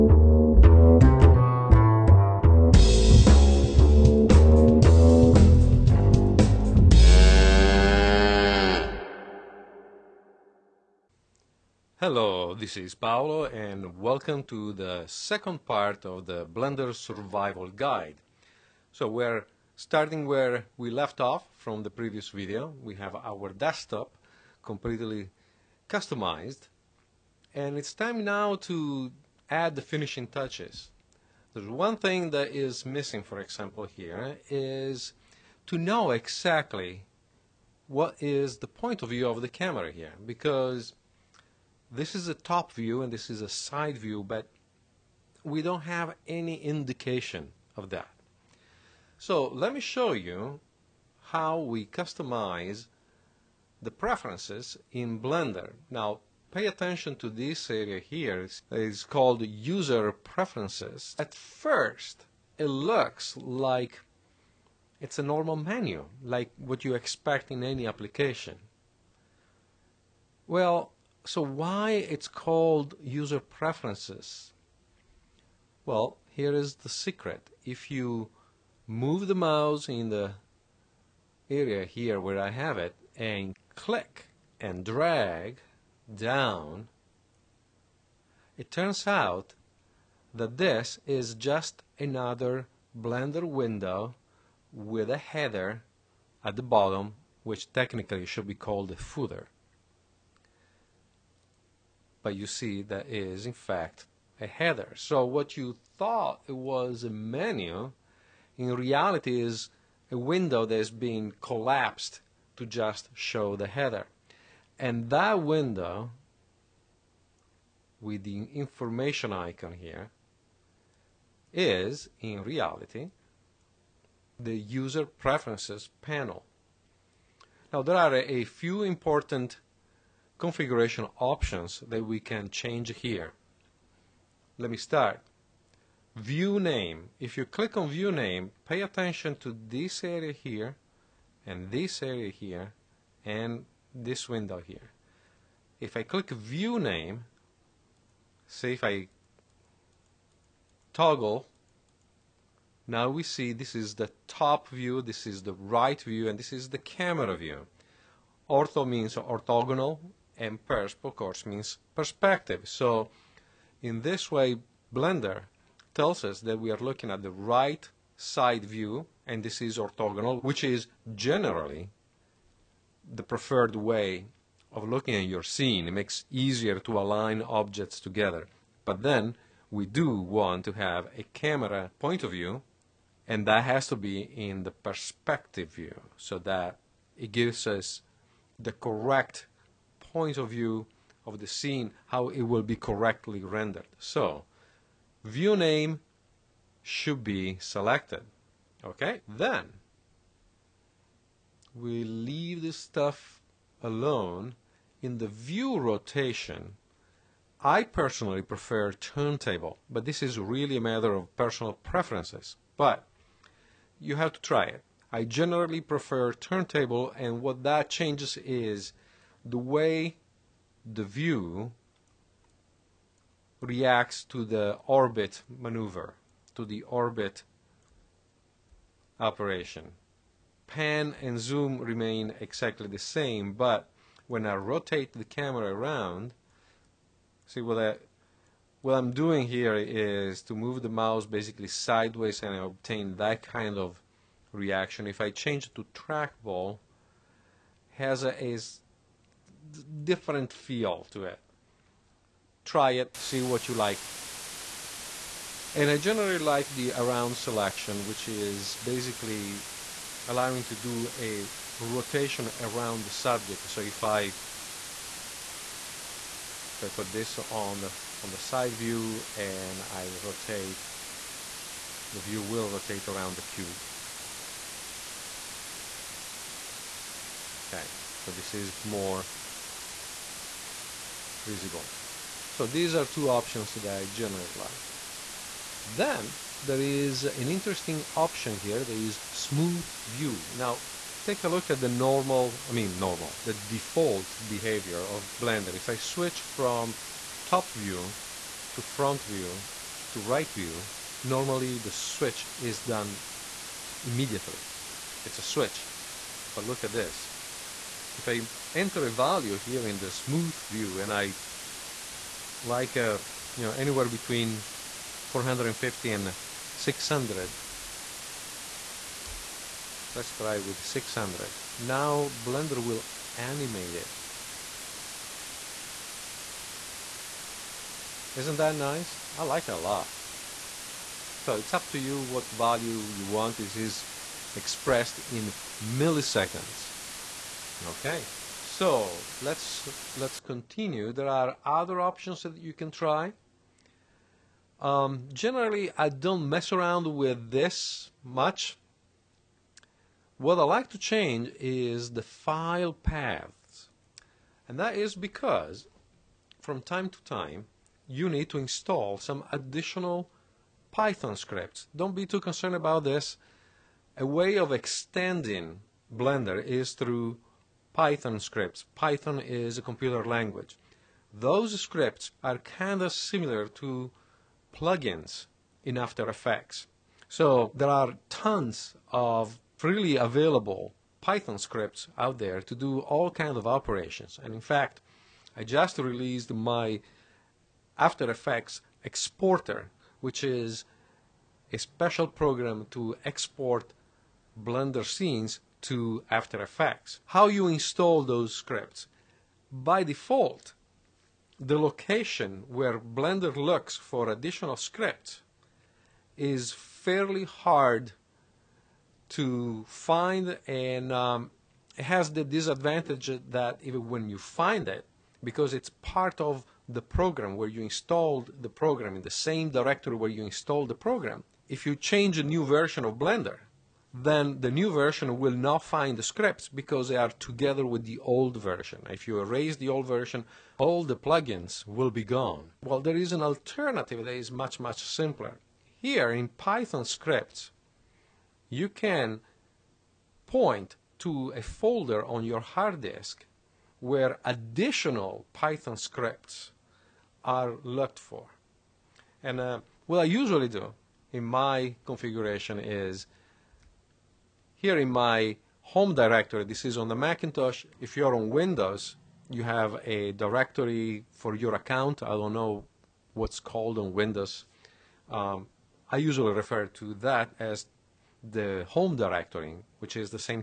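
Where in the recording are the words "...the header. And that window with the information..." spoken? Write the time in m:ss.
1:53.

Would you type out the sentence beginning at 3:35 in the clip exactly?
I generally prefer turntable, and what that changes is the way the view reacts to the orbit maneuver, to the orbit operation.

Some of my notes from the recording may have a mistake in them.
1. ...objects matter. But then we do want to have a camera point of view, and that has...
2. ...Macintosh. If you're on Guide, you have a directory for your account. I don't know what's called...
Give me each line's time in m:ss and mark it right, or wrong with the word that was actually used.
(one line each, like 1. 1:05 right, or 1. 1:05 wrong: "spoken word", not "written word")
1. 2:57 wrong: "together", not "matter"
2. 7:37 wrong: "Windows", not "Guide".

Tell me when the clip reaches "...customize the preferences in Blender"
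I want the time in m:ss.
0:51.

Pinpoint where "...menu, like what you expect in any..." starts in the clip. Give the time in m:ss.
1:05.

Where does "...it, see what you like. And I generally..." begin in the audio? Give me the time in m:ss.
4:12.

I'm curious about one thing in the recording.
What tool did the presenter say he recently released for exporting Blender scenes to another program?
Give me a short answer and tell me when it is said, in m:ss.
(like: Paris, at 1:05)
After Effects exporter, at 6:27.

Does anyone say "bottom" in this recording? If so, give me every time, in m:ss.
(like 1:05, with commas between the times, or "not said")
1:36.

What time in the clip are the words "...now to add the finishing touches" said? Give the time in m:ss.
0:28.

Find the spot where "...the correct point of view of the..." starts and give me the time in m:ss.
3:08.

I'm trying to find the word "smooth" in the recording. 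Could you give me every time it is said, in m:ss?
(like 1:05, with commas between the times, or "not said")
4:49, 5:10.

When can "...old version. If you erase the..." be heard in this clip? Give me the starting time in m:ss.
7:08.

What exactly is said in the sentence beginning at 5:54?
And that is because from time to time, you need to install some additional Python scripts.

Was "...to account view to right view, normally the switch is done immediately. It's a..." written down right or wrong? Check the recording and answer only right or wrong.
wrong.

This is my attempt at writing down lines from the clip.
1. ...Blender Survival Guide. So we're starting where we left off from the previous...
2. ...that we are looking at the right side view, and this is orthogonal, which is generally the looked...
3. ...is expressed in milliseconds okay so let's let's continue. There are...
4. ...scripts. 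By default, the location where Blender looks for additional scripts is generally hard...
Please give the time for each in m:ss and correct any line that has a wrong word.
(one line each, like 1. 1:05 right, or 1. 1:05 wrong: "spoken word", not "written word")
1. 0:16 right
2. 2:46 wrong: "preferred", not "looked"
3. 5:33 right
4. 6:38 wrong: "fairly", not "generally".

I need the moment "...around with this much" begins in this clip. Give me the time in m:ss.
5:46.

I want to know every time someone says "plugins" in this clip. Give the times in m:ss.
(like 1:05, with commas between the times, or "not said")
6:14, 7:11.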